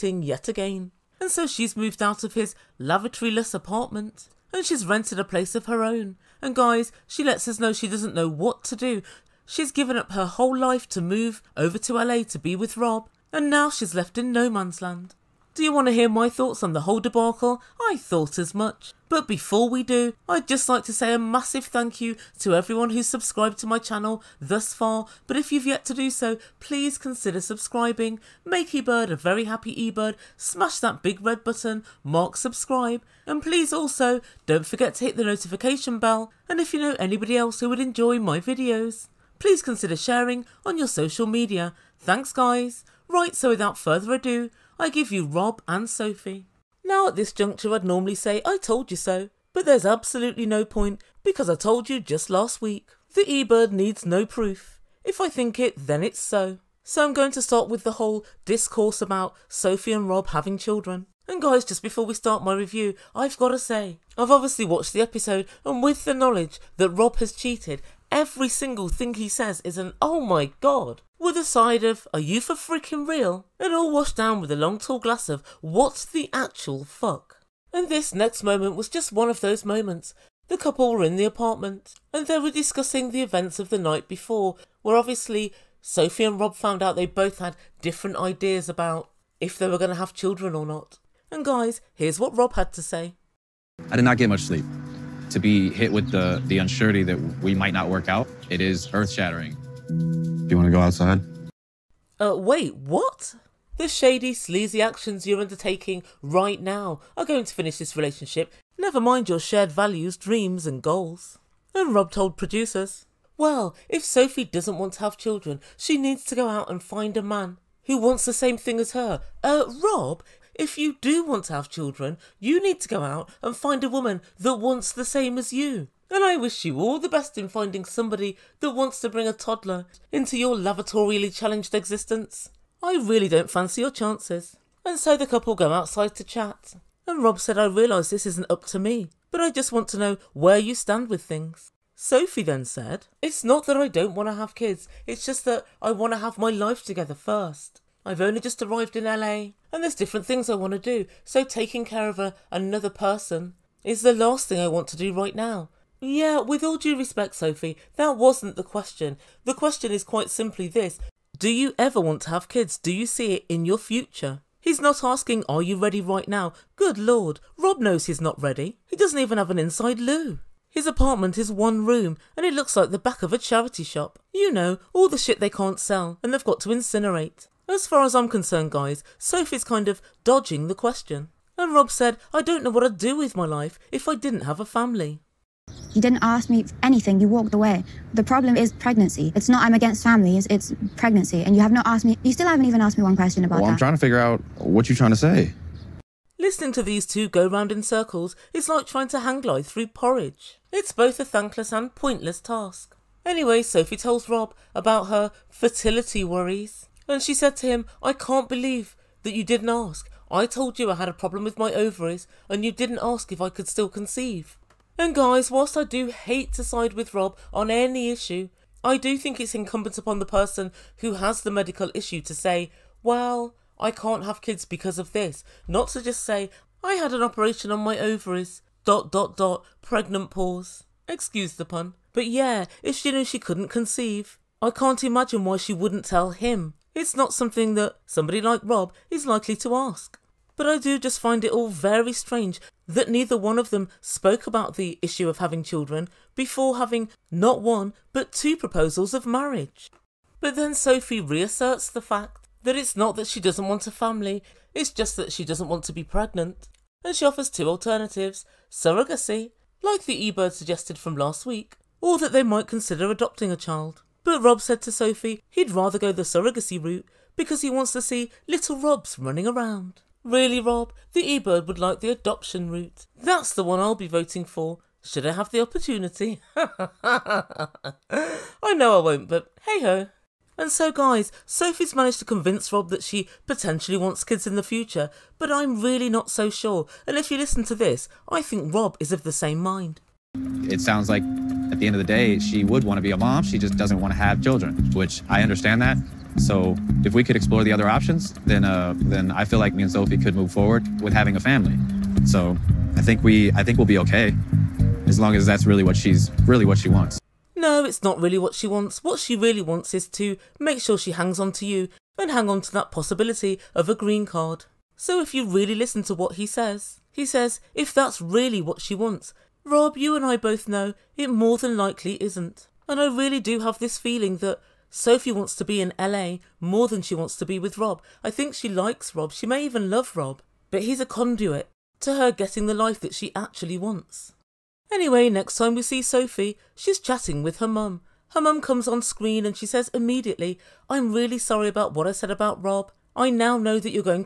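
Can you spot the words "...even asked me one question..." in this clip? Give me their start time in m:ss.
3:12.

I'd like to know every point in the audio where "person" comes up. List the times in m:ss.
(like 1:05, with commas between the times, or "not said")
2:32, 3:40.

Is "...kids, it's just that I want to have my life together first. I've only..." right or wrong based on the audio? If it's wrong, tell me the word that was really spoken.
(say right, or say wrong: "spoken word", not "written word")
right.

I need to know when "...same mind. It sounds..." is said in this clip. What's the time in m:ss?
4:49.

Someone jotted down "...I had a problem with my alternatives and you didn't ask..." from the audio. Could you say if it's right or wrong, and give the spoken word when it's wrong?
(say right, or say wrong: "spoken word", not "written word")
wrong: "ovaries", not "alternatives".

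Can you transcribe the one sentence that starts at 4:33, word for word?
That's the one I'll be voting for, should I have the opportunity.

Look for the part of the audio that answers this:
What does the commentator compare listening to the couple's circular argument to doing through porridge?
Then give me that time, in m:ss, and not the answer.
3:19.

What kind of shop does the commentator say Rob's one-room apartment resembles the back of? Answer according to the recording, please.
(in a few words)
charity shop.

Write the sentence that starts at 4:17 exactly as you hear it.
And she offers two alternatives surrogacy, like the eBird suggested from last week, or that they might consider adopting a child.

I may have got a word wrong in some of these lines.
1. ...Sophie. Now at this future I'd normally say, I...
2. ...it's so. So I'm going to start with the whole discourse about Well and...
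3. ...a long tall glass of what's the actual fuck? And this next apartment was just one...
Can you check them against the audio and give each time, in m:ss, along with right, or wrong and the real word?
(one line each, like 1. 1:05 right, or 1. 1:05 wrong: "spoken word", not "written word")
1. 0:45 wrong: "juncture", not "future"
2. 0:56 wrong: "Sophie", not "Well"
3. 1:14 wrong: "moment", not "apartment".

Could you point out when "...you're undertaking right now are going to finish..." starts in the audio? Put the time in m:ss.
1:45.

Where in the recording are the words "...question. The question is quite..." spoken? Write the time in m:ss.
2:38.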